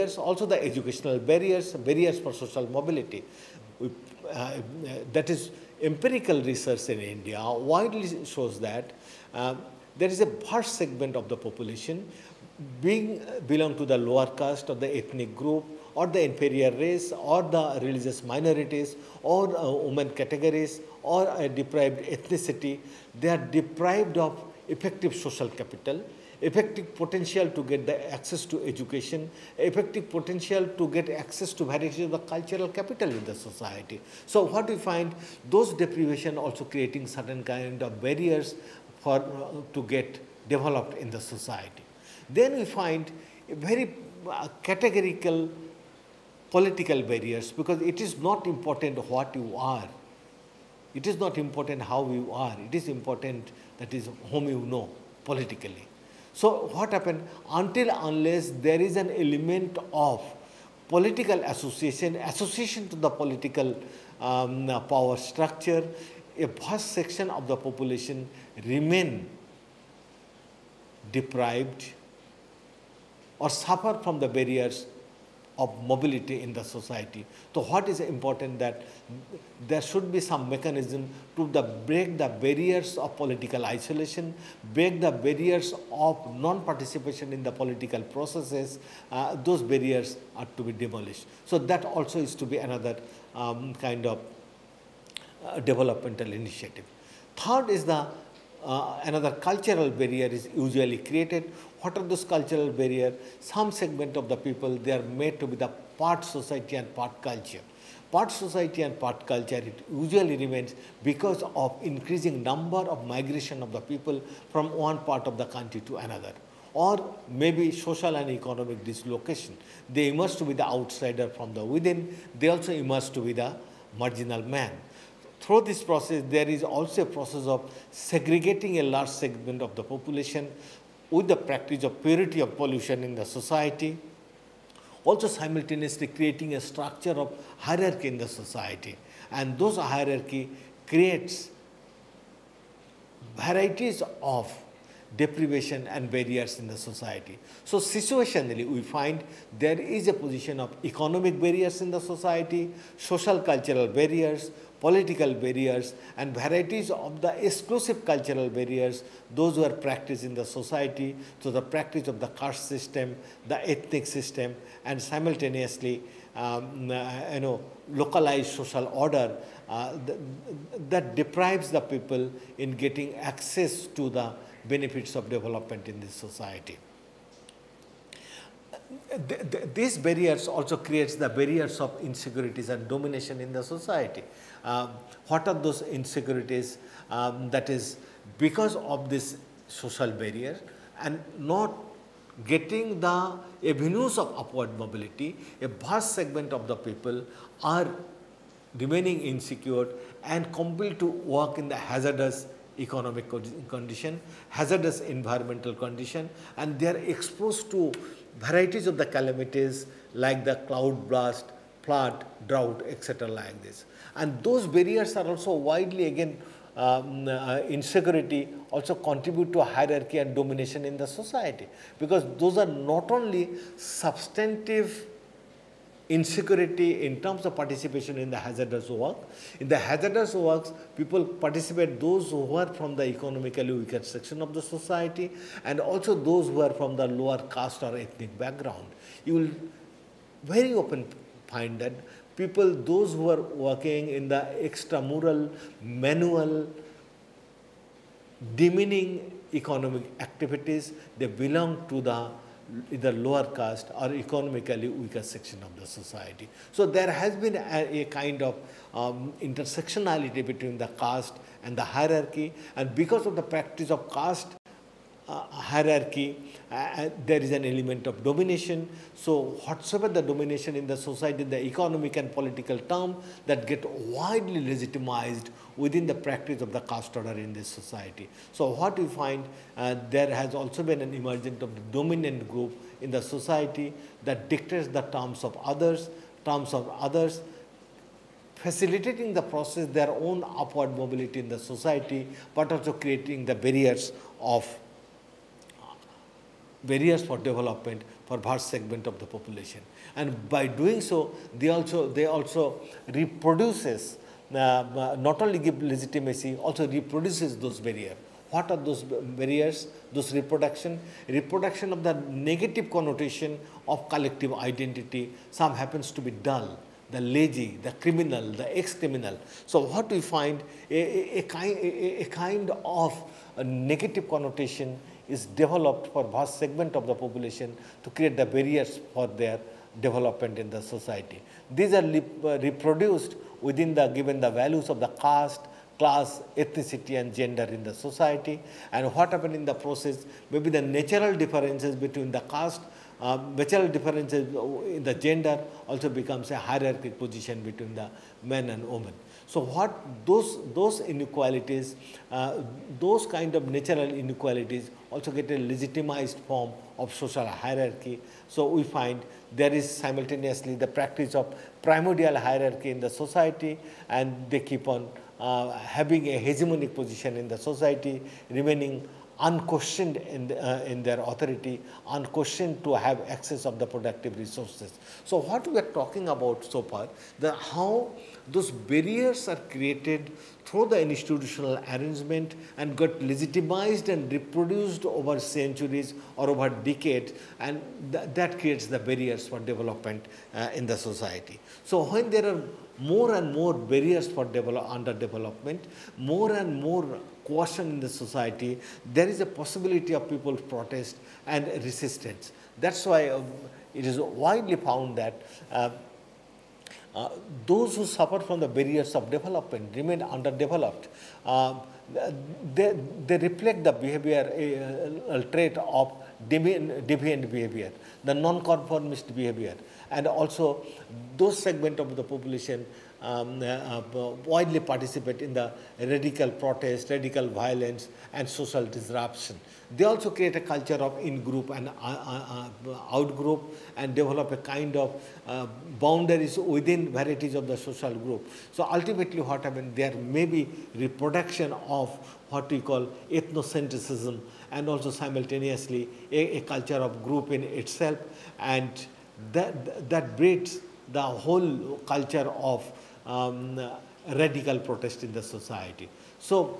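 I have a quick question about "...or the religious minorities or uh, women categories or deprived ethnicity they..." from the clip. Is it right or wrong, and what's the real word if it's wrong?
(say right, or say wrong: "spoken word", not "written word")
right.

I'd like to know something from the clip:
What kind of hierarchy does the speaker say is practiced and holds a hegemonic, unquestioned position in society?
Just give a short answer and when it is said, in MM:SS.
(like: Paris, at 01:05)
primordial hierarchy, at 06:01.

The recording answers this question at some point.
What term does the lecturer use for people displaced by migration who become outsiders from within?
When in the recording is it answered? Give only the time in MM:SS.
02:03.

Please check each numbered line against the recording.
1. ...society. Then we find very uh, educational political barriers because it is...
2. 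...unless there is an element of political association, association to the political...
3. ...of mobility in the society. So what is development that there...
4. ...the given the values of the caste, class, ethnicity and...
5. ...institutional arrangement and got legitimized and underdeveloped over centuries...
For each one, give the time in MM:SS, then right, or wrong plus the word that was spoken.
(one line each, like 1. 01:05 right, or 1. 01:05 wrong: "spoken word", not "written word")
1. 00:41 wrong: "categorical", not "educational"
2. 00:58 right
3. 01:15 wrong: "important", not "development"
4. 05:33 right
5. 06:21 wrong: "reproduced", not "underdeveloped".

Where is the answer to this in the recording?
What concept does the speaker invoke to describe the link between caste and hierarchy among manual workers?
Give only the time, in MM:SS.
04:19.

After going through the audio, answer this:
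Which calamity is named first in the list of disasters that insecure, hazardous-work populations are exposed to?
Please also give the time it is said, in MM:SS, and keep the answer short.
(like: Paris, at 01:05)
cloud blast, at 03:30.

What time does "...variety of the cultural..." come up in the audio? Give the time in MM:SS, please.
00:31.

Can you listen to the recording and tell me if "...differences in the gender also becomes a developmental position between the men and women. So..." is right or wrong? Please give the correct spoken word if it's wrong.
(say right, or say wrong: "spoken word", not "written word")
wrong: "hierarchical", not "developmental".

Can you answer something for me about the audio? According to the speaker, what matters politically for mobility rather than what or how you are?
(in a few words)
whom you know.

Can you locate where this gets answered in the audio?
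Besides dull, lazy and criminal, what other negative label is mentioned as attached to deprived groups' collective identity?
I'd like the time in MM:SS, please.
05:18.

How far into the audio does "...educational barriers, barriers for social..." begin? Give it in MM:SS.
00:00.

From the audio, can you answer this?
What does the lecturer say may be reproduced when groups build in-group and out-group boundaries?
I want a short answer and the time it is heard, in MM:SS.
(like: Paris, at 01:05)
ethnocentrism, at 07:23.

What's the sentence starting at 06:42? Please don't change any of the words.
That's why uh, it is widely found that uh, uh, those who suffer from the barriers of development remain underdeveloped.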